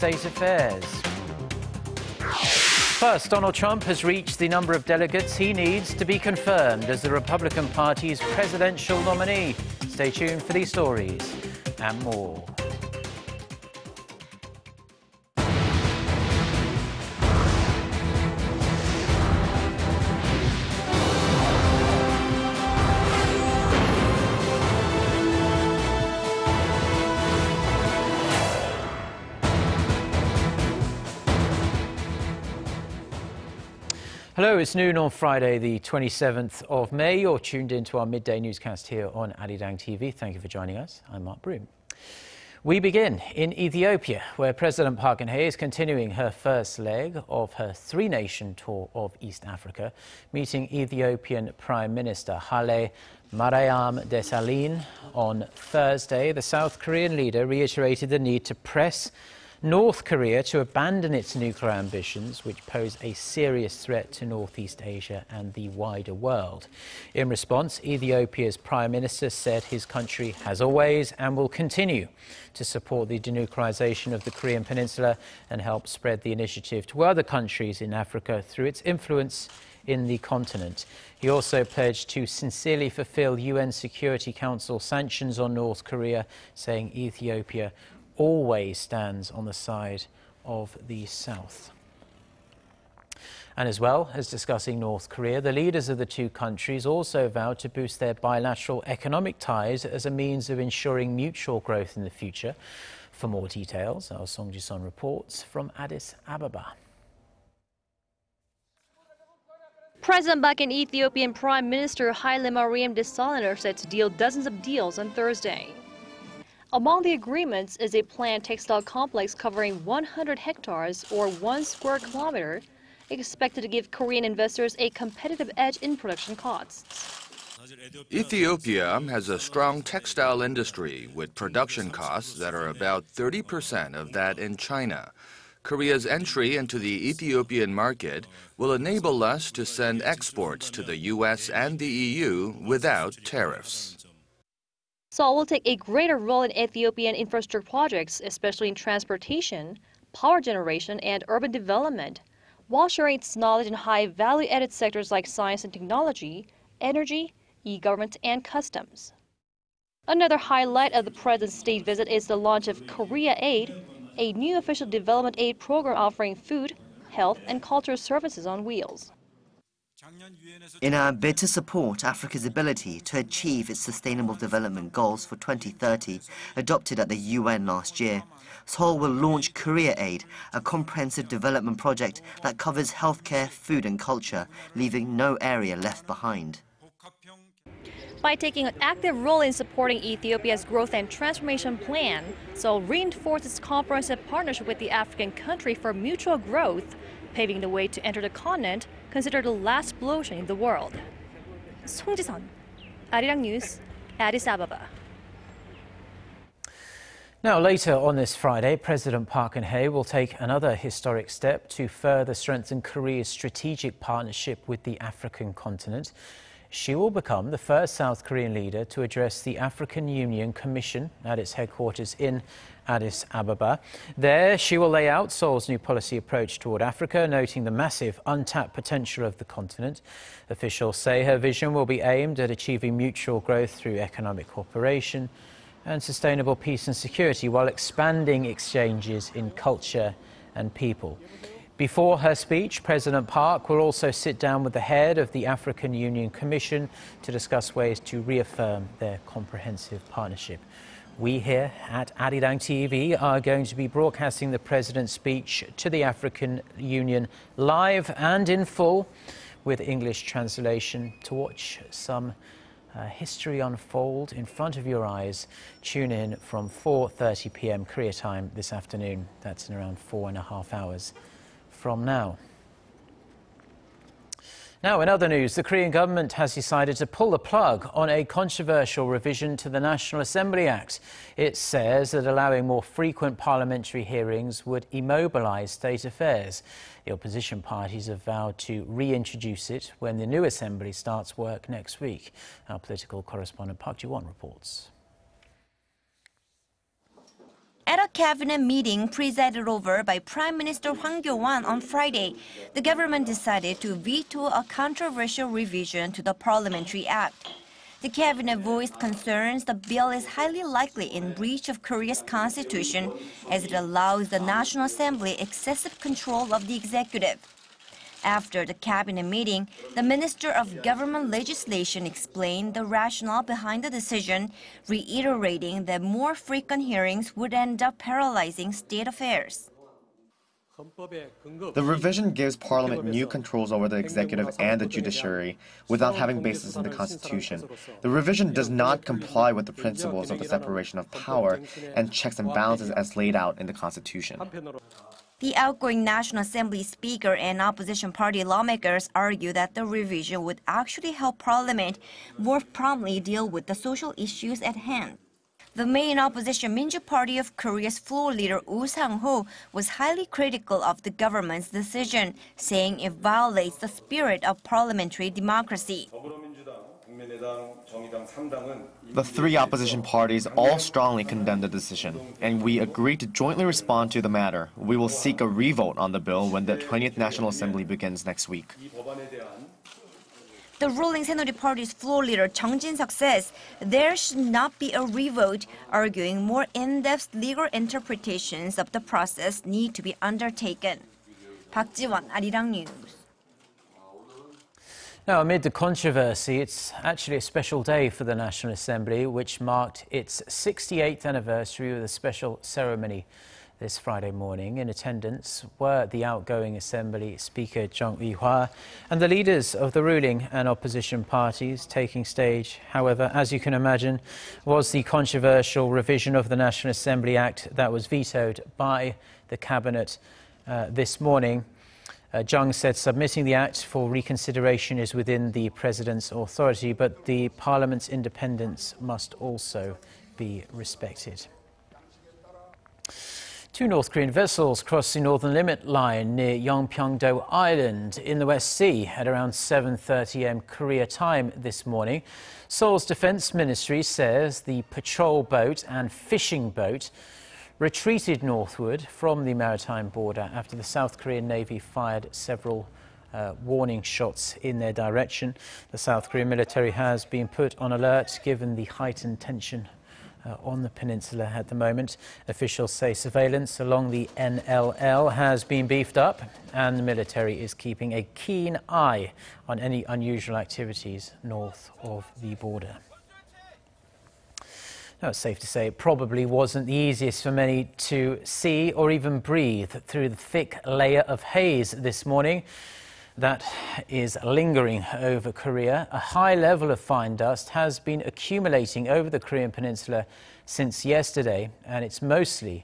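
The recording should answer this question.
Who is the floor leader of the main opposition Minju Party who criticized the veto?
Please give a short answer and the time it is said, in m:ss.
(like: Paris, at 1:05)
Oh Sang-ho, at 5:58.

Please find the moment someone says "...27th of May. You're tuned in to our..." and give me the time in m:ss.
0:35.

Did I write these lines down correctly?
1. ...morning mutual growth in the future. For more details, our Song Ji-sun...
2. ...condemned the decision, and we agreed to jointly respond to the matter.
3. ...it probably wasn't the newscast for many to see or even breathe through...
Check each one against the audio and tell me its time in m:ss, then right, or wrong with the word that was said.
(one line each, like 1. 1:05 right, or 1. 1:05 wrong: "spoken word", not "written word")
1. 1:40 wrong: "ensuring", not "morning"
2. 6:11 right
3. 7:55 wrong: "easiest", not "newscast".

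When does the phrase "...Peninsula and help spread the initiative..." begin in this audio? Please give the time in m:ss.
1:14.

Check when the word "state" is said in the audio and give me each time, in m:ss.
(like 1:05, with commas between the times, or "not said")
2:41, 4:45, 5:28.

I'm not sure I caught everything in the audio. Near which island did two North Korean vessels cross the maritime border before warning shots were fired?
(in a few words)
Yeonpyeongdo.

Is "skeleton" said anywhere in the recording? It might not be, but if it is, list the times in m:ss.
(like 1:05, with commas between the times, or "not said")
not said.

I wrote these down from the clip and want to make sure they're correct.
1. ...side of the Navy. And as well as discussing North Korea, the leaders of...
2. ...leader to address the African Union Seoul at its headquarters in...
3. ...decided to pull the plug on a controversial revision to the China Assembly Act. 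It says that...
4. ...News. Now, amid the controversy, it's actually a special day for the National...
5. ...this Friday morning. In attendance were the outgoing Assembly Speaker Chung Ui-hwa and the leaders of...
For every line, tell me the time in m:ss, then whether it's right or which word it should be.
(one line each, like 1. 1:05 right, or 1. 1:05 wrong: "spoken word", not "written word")
1. 1:29 wrong: "South", not "Navy"
2. 3:38 wrong: "Commission", not "Seoul"
3. 4:36 wrong: "National", not "China"
4. 6:32 right
5. 6:43 right.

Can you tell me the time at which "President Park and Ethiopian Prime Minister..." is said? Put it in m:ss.
1:50.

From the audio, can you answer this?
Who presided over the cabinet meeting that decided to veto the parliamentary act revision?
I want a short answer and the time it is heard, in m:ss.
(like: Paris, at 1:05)
Hwang Kyo-won, at 5:00.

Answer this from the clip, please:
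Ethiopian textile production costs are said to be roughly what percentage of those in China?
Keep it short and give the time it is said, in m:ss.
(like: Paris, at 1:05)
30%, at 2:13.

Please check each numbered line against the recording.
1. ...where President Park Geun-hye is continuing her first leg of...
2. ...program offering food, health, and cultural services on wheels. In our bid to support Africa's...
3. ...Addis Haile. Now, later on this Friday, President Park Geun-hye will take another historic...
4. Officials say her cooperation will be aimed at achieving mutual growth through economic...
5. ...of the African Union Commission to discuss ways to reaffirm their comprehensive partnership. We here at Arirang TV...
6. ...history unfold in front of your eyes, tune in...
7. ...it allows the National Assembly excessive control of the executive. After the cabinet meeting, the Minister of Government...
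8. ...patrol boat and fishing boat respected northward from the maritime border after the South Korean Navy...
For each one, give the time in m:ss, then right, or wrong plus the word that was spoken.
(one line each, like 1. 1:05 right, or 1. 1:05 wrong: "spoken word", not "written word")
1. 0:44 right
2. 2:45 right
3. 3:24 wrong: "Ababa", not "Haile"
4. 3:50 wrong: "vision", not "cooperation"
5. 4:05 right
6. 4:23 right
7. 5:13 right
8. 7:24 wrong: "retreated", not "respected".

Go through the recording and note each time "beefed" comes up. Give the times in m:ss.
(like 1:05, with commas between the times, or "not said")
7:45.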